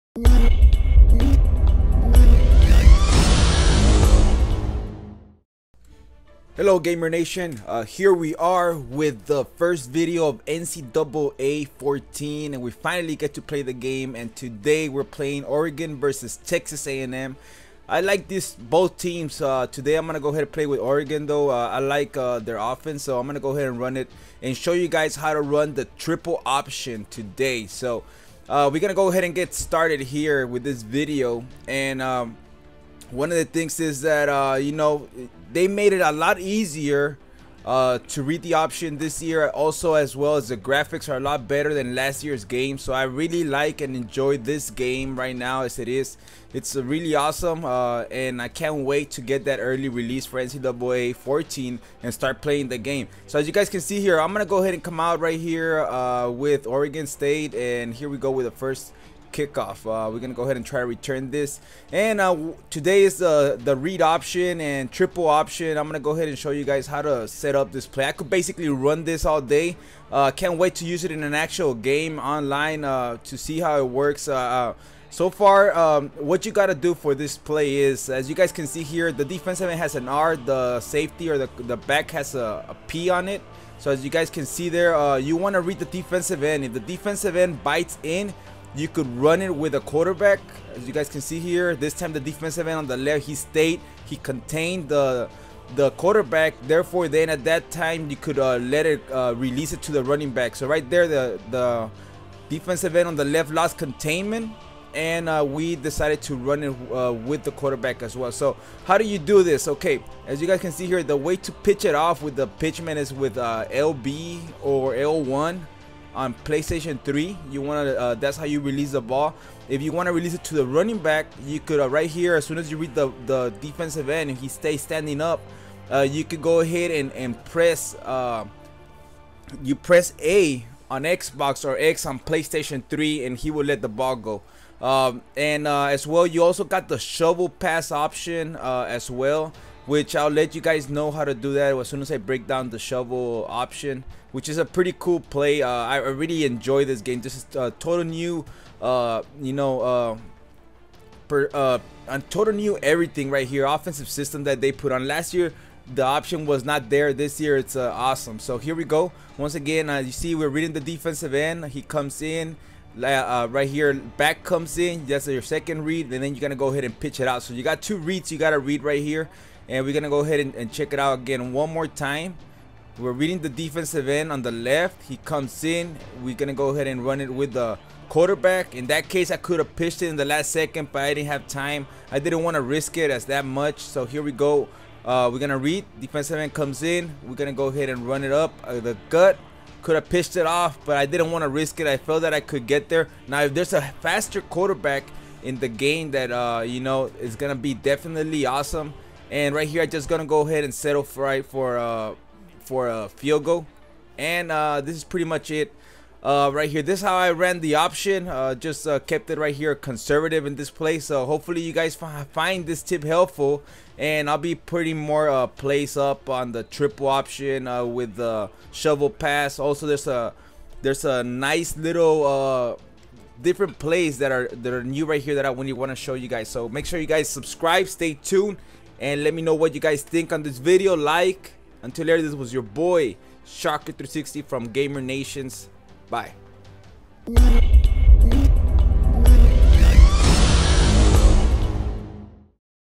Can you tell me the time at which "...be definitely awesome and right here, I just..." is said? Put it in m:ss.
3:17.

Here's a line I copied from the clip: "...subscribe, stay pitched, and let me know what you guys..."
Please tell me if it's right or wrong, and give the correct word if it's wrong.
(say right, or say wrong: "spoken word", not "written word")
wrong: "tuned", not "pitched".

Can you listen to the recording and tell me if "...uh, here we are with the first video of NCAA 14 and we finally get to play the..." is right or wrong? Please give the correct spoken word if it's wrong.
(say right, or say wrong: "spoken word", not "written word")
right.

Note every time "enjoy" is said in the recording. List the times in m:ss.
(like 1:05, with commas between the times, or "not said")
0:43, 2:26.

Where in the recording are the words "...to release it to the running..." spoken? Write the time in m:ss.
2:00.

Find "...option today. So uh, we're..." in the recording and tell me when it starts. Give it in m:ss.
0:26.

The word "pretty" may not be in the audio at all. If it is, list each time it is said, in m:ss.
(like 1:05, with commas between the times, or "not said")
2:24, 3:25.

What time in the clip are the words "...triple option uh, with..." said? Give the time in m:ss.
3:36.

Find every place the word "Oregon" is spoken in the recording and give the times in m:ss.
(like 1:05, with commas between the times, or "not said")
0:15, 0:20, 0:56.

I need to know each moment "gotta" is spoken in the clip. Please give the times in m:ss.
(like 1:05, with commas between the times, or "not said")
1:16, 2:48.